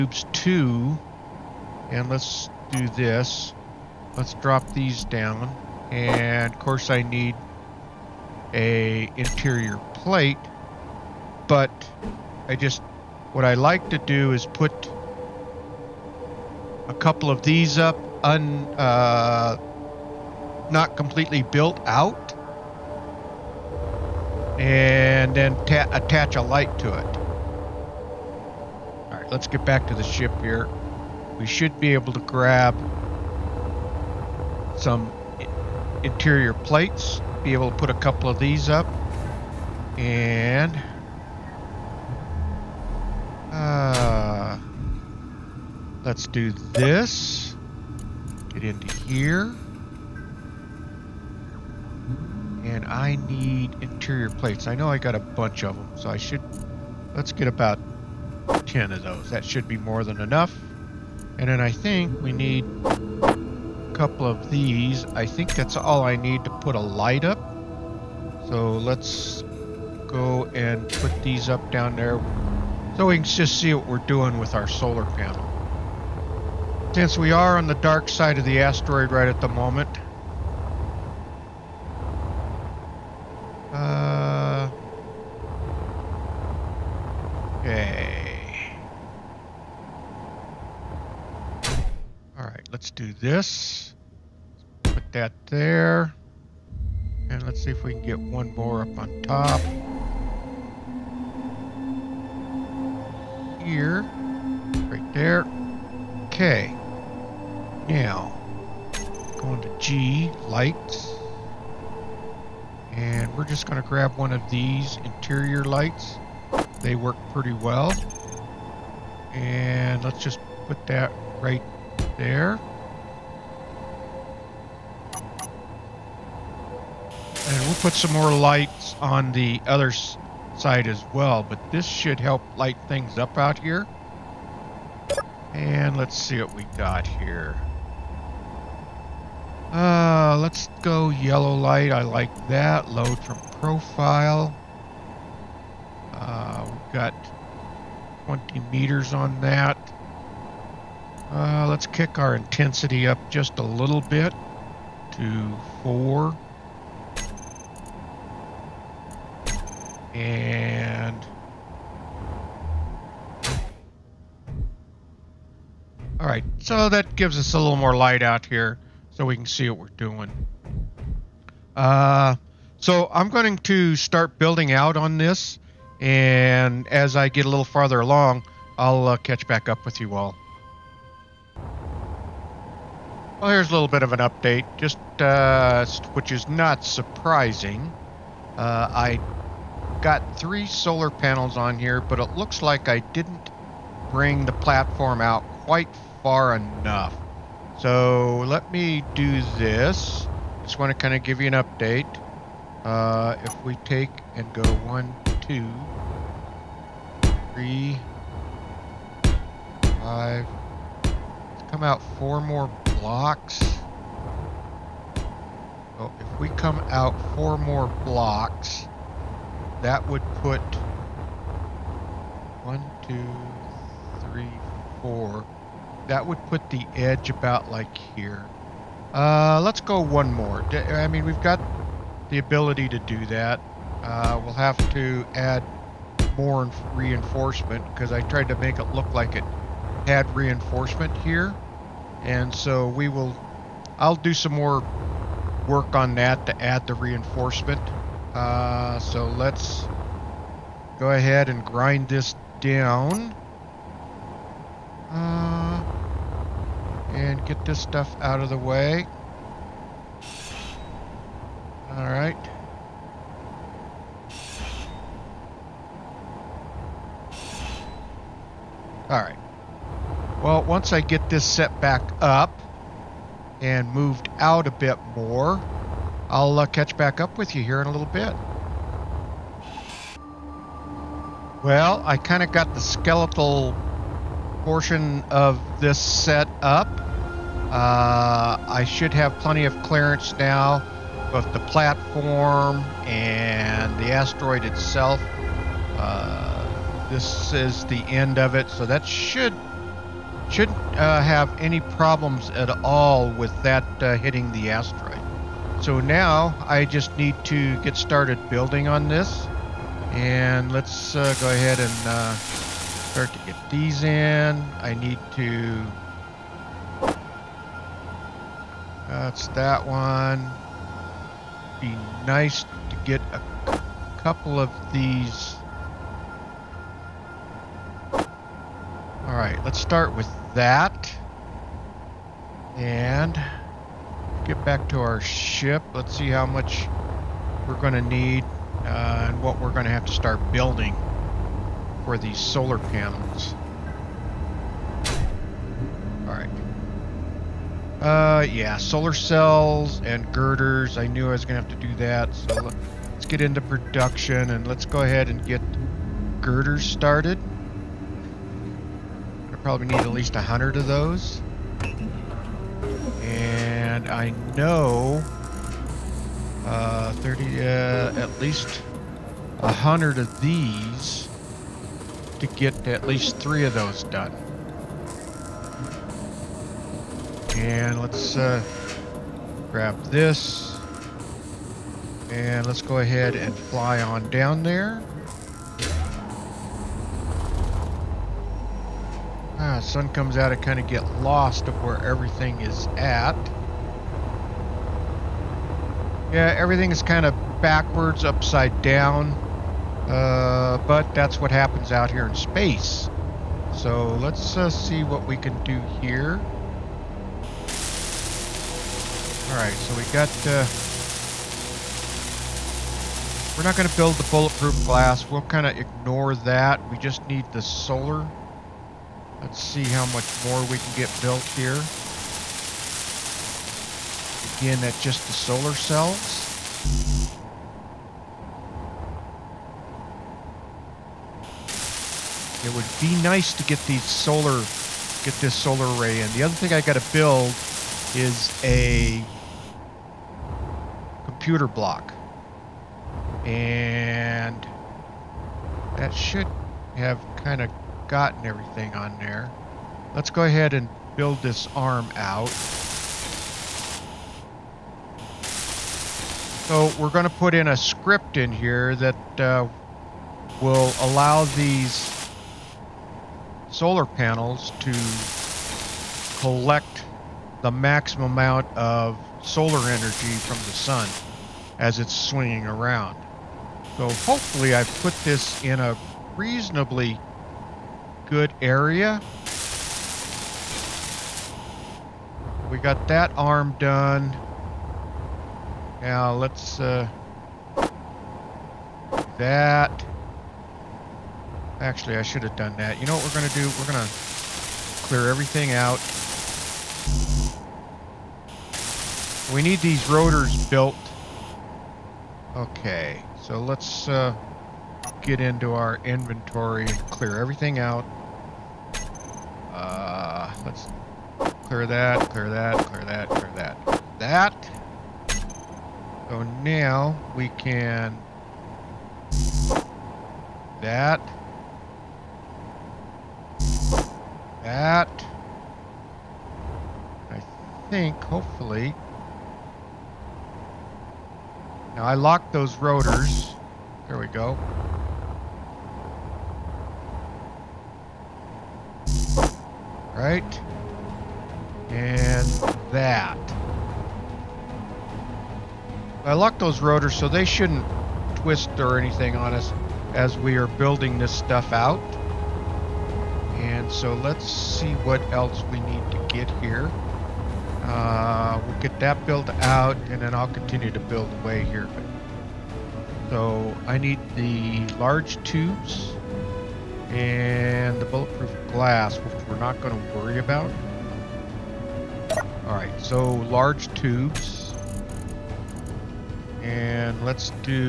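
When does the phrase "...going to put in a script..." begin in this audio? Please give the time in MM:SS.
07:37.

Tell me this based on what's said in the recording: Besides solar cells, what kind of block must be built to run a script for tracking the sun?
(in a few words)
Computer block.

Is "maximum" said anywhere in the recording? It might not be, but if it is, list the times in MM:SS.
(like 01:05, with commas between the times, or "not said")
07:47.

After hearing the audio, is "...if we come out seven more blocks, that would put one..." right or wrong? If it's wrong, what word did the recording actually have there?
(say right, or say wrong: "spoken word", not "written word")
wrong: "four", not "seven".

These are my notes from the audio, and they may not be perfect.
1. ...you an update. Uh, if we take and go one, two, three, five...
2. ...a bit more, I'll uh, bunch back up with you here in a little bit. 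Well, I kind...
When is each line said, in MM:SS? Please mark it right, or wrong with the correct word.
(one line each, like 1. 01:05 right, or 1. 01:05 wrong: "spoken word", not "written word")
1. 03:21 right
2. 04:34 wrong: "catch", not "bunch".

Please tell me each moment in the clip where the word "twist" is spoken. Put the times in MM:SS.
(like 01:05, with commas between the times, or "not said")
09:08.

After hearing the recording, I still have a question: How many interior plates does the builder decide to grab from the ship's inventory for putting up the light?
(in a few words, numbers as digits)
10.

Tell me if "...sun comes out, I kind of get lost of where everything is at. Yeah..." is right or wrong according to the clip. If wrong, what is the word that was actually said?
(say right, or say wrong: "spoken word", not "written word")
right.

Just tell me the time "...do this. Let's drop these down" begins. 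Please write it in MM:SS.
00:02.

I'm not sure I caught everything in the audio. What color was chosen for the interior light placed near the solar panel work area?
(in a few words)
Yellow.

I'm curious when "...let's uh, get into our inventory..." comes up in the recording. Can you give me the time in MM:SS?
08:23.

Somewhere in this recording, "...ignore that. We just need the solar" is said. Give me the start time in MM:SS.
06:55.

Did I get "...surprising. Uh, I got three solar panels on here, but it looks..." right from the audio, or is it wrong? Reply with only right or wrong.
right.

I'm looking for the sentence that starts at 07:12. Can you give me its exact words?
It would be nice to get these solar, get this solar array in.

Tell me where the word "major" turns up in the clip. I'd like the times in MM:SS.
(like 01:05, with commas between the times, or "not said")
not said.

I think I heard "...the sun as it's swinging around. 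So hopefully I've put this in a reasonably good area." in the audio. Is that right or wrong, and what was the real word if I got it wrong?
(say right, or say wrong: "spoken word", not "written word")
right.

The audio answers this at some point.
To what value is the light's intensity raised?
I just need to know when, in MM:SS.
02:35.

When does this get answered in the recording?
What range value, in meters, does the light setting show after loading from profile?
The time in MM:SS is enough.
02:28.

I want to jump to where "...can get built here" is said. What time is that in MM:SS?
07:00.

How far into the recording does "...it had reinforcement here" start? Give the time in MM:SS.
03:59.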